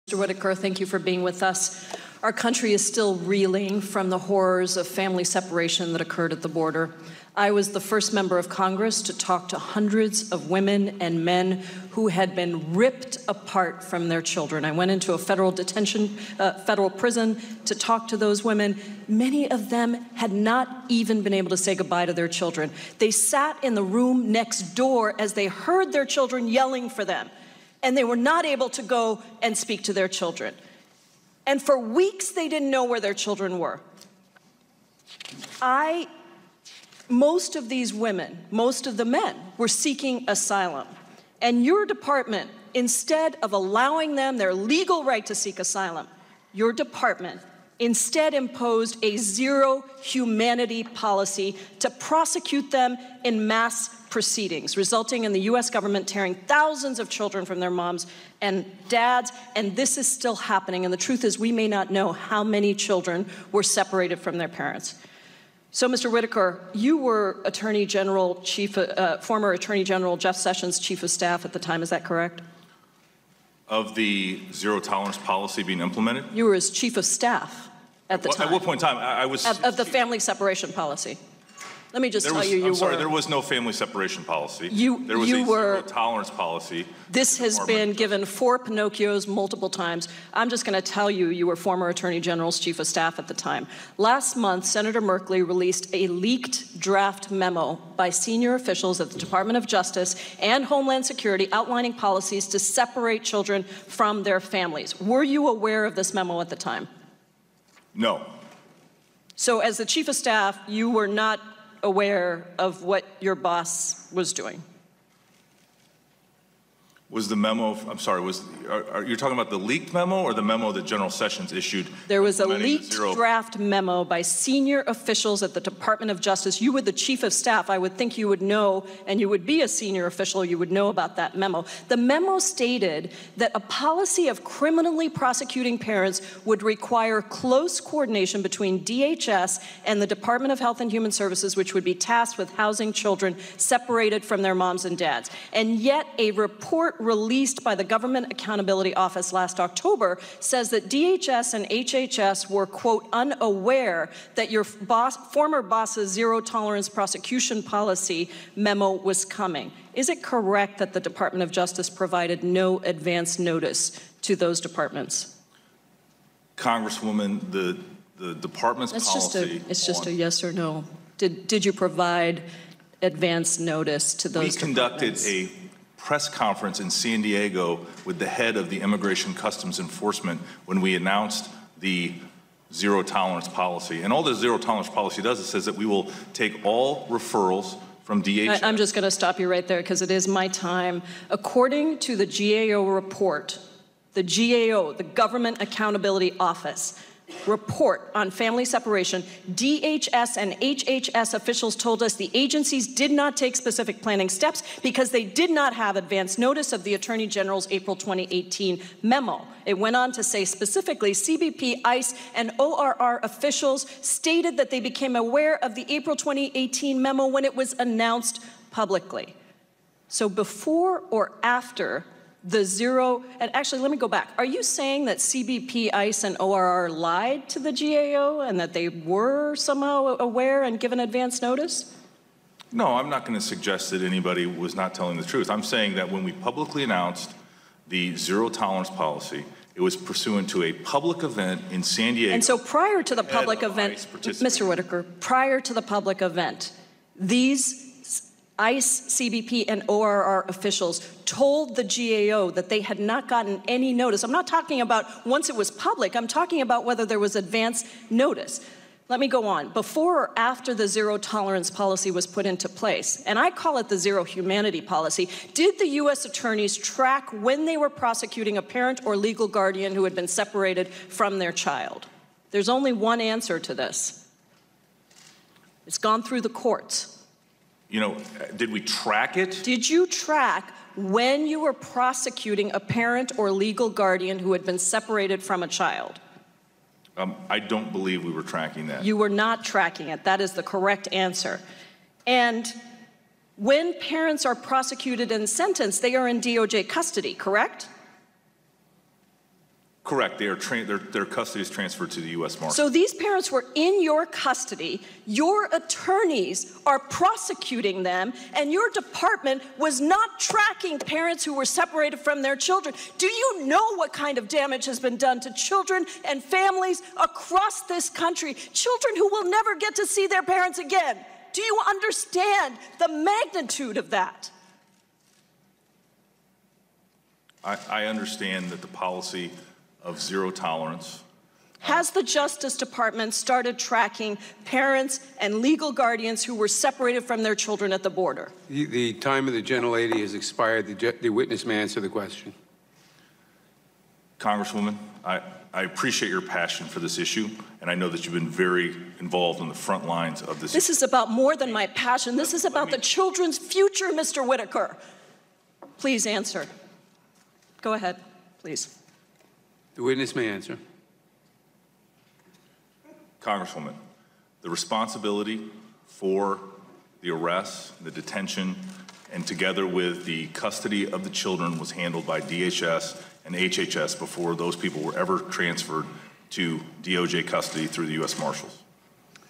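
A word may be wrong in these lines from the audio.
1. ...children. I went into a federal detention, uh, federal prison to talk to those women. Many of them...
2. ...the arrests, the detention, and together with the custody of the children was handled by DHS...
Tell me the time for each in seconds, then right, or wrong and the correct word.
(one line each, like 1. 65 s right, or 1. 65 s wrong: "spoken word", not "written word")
1. 14 s right
2. 367 s right.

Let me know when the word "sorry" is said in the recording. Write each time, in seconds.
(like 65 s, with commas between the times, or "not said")
82 s, 117 s.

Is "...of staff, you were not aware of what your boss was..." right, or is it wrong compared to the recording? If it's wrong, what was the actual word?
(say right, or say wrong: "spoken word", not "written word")
right.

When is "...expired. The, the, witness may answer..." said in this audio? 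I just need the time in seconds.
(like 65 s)
340 s.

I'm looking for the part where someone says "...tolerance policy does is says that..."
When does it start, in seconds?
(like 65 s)
184 s.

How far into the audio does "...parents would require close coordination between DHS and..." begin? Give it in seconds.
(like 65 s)
135 s.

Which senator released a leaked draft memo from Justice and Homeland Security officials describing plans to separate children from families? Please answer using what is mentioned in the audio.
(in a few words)
Senator Merkley.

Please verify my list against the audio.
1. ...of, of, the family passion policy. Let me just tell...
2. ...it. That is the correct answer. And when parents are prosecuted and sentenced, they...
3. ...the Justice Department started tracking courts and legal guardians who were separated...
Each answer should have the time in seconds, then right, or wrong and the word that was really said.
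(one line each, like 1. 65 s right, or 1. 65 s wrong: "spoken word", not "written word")
1. 79 s wrong: "separation", not "passion"
2. 290 s right
3. 332 s wrong: "parents", not "courts".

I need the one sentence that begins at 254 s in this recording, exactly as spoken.
I'm not talking about once it was public, I'm talking about whether there was advance notice.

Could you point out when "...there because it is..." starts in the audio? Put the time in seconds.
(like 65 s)
189 s.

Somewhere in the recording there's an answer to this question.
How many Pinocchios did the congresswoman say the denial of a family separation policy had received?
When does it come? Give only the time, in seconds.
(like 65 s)
88 s.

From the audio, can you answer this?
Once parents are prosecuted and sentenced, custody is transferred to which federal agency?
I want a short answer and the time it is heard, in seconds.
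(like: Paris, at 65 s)
U.S. Marshal, at 302 s.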